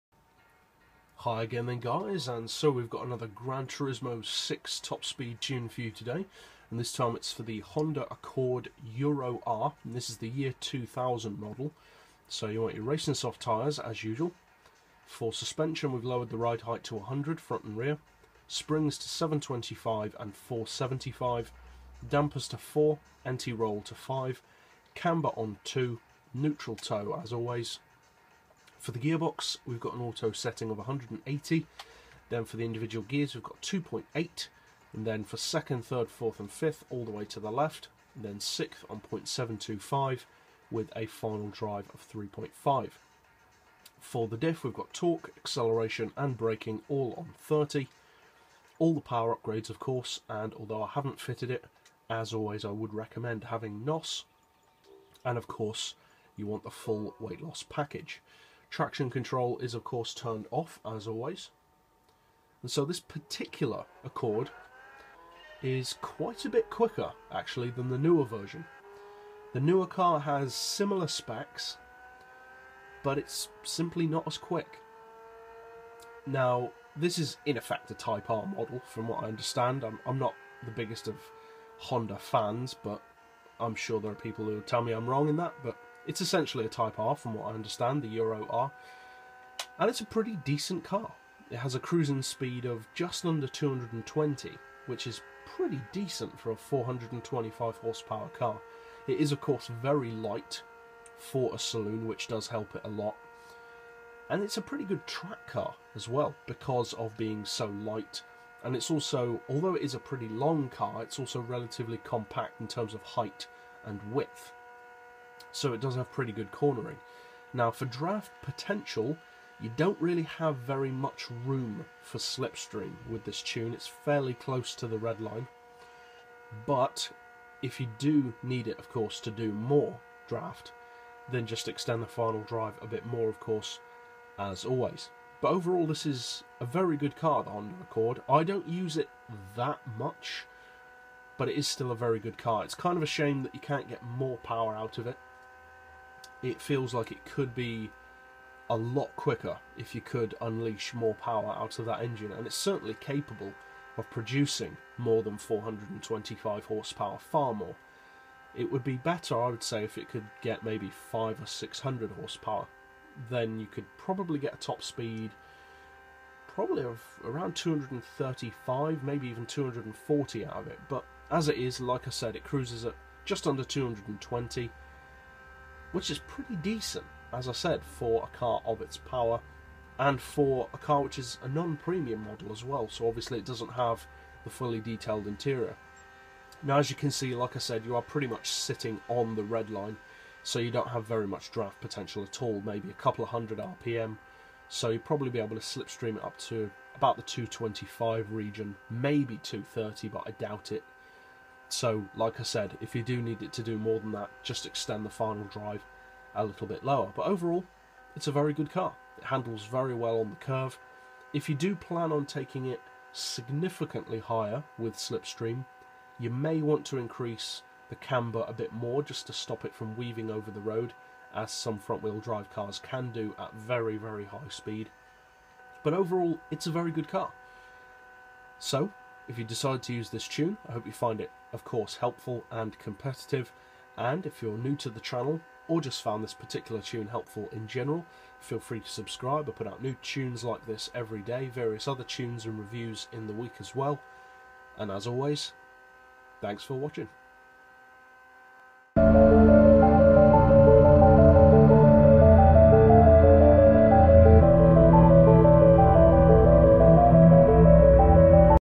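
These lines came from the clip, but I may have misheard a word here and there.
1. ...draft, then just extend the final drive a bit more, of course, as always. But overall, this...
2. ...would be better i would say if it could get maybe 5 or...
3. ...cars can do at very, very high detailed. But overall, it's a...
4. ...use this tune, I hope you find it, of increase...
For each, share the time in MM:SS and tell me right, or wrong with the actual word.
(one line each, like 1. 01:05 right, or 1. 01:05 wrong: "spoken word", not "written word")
1. 02:10 right
2. 02:38 right
3. 03:42 wrong: "speed", not "detailed"
4. 03:49 wrong: "course", not "increase".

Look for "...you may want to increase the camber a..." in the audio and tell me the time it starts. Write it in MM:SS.
03:36.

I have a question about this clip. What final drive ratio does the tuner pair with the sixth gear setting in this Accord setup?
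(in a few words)
3.5.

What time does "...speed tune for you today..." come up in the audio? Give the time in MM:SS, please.
00:05.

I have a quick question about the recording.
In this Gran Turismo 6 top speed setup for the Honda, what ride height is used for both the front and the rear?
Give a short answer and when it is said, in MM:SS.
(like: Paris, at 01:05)
100, at 00:16.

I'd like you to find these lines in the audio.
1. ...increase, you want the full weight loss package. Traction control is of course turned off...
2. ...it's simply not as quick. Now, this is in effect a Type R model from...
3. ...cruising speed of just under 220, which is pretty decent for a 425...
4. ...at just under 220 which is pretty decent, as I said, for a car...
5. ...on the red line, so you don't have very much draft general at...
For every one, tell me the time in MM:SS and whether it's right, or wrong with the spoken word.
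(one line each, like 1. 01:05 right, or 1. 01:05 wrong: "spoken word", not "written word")
1. 00:55 wrong: "course", not "increase"
2. 01:13 right
3. 01:31 right
4. 02:52 right
5. 03:09 wrong: "potential", not "general".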